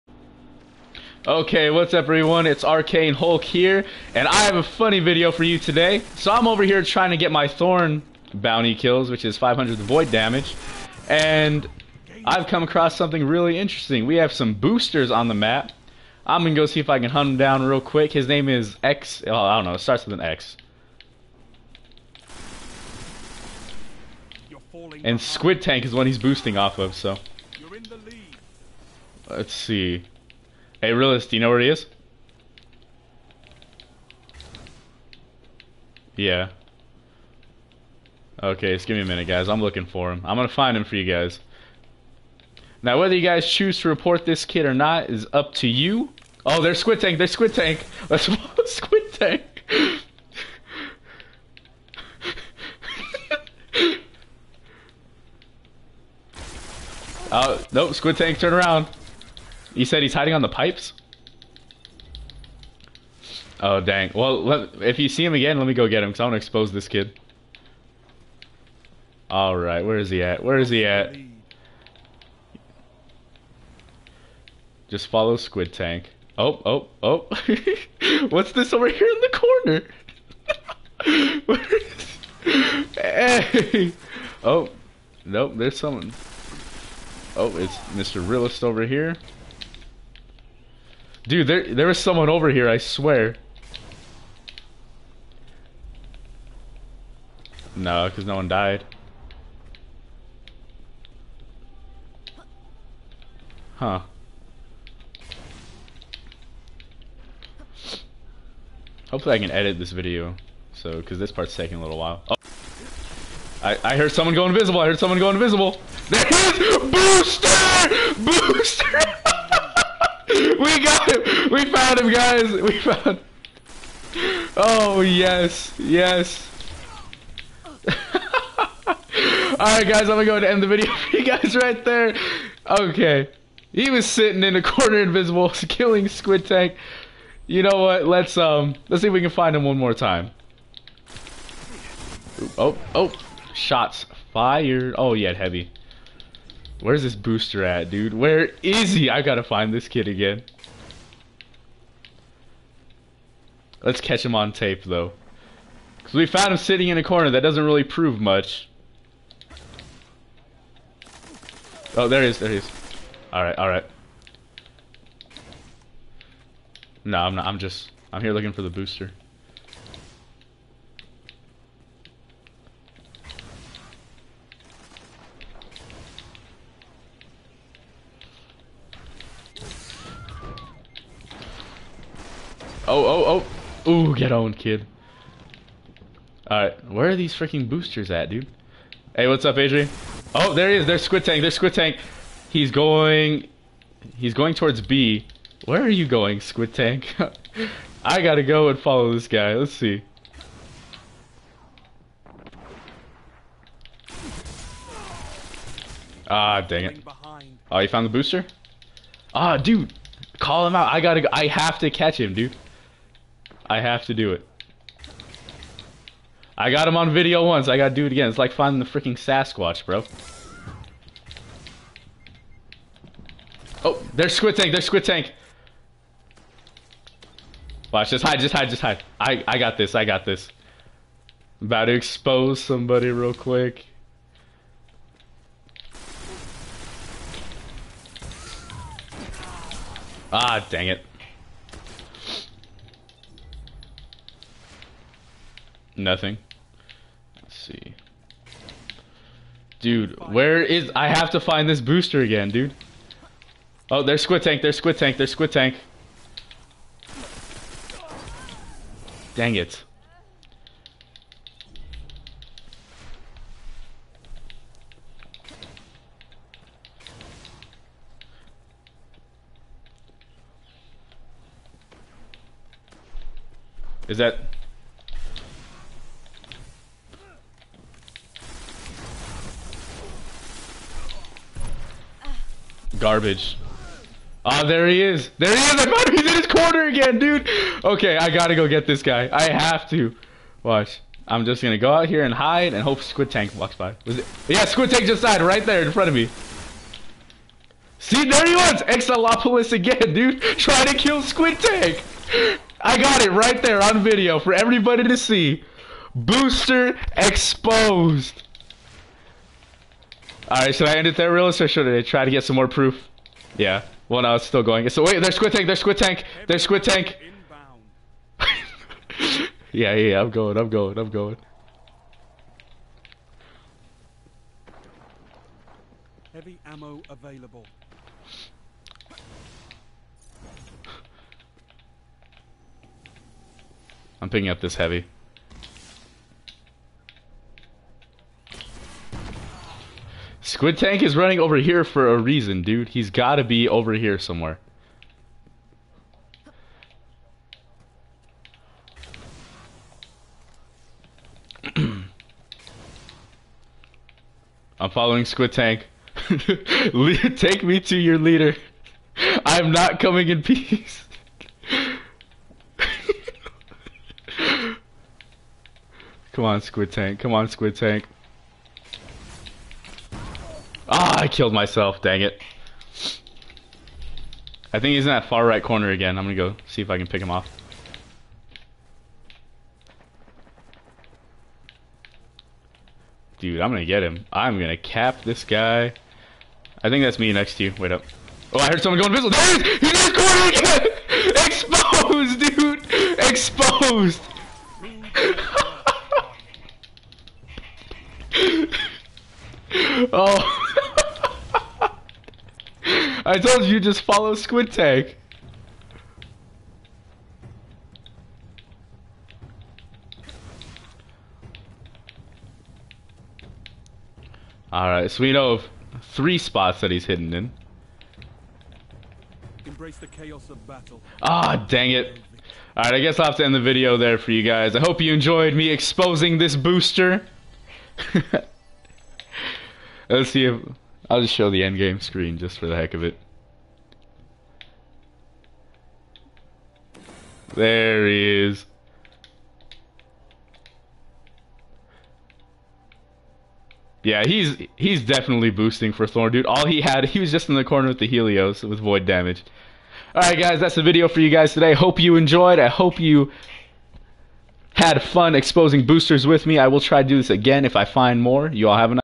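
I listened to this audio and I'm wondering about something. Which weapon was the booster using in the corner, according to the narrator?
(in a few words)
Helios.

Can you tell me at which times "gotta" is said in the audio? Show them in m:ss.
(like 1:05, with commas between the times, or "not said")
2:29, 3:18, 3:30, 3:37, 4:48.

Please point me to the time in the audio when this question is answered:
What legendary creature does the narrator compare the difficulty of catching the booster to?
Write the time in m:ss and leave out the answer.
3:39.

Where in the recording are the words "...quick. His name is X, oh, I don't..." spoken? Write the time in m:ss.
0:17.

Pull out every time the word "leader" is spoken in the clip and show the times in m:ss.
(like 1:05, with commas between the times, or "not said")
5:58.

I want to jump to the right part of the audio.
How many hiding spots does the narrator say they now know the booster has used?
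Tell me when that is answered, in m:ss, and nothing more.
6:56.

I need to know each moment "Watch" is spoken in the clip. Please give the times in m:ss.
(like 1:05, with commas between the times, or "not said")
3:47, 4:50.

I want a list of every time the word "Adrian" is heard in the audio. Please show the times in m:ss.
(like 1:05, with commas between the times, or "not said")
3:09.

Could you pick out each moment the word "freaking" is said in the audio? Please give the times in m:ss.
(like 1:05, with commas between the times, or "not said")
3:07, 3:38.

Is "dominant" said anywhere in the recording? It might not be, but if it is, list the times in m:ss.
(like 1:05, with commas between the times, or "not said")
not said.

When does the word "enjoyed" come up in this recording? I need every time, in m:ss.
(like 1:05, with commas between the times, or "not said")
7:05, 7:32.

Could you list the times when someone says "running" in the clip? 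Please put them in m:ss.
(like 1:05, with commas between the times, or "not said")
5:41.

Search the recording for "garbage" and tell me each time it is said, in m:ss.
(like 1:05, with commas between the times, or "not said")
4:43.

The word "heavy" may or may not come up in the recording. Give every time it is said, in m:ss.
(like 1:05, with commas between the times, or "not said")
2:25, 5:26, 5:34.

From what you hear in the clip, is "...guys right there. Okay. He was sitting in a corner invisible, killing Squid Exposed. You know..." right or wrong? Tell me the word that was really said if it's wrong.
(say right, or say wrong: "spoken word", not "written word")
wrong: "Tank", not "Exposed".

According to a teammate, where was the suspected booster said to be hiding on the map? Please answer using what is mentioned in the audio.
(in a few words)
On the pipes.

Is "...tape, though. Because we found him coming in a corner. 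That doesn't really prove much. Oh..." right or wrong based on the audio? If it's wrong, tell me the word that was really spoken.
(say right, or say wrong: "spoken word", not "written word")
wrong: "sitting", not "coming".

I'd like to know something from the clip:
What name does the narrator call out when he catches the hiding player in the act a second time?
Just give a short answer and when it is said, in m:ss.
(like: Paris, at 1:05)
Exalopolis, at 4:58.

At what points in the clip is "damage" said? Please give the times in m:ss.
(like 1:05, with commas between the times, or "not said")
0:10, 7:29.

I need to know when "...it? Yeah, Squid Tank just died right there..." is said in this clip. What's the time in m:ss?
4:54.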